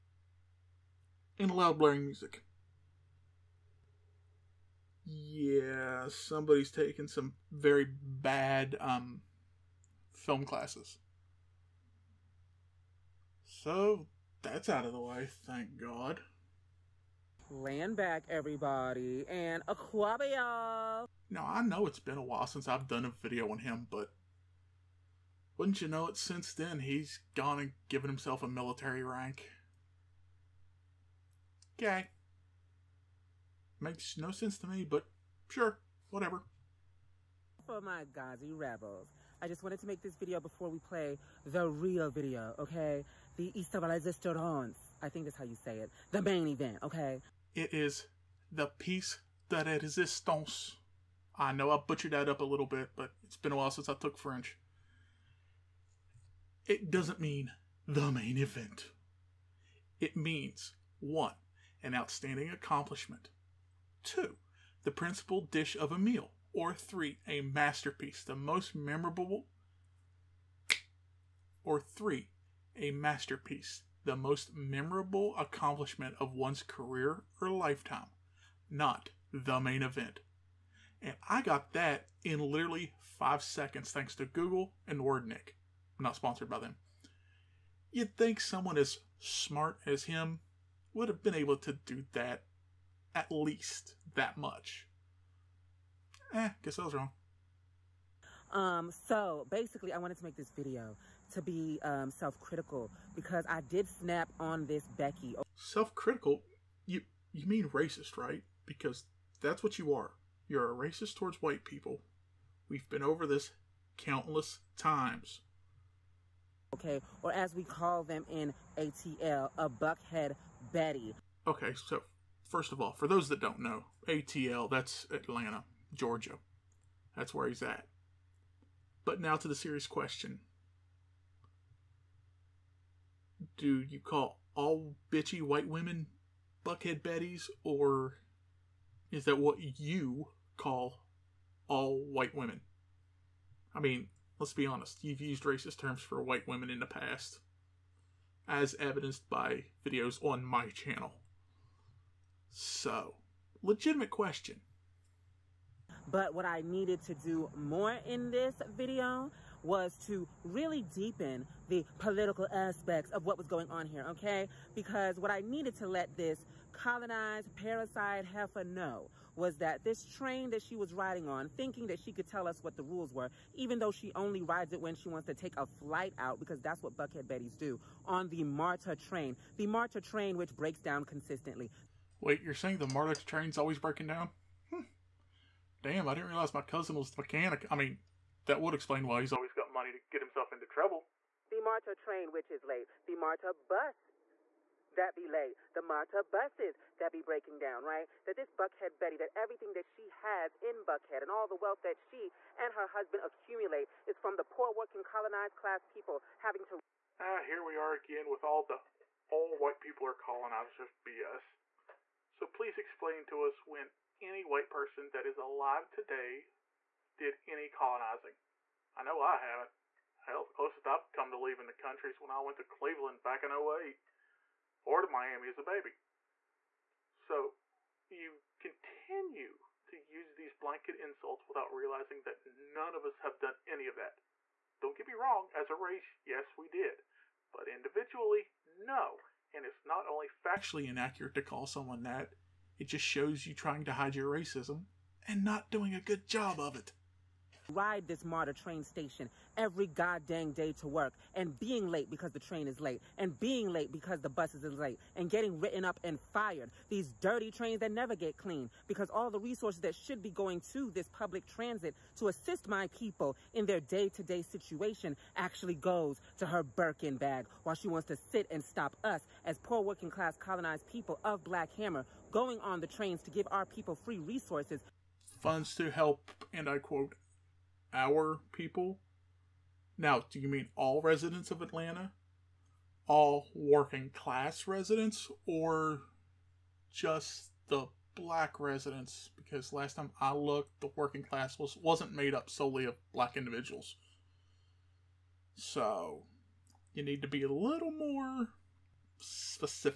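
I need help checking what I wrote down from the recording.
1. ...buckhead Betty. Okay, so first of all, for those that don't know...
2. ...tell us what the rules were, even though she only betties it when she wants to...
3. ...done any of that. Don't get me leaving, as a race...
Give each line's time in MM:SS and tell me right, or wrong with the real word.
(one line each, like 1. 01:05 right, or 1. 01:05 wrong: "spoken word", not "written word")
1. 01:59 right
2. 02:52 wrong: "rides", not "betties"
3. 03:53 wrong: "wrong", not "leaving".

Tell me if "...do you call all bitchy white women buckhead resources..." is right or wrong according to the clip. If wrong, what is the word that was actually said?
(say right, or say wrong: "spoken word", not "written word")
wrong: "betties", not "resources".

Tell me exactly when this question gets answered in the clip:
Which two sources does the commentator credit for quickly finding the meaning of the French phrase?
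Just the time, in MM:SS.
01:24.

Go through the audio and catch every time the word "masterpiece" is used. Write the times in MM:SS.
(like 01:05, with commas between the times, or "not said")
01:07, 01:12.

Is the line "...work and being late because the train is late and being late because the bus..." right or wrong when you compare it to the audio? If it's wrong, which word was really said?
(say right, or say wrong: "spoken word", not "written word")
right.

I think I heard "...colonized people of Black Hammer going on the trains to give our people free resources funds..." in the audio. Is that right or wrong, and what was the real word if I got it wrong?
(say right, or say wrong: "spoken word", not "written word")
right.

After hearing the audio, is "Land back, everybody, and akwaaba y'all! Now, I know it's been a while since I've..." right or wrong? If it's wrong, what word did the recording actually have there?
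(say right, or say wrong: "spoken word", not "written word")
right.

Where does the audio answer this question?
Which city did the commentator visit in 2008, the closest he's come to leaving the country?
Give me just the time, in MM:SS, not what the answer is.
03:42.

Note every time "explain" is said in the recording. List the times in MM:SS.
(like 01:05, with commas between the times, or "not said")
03:08, 03:32.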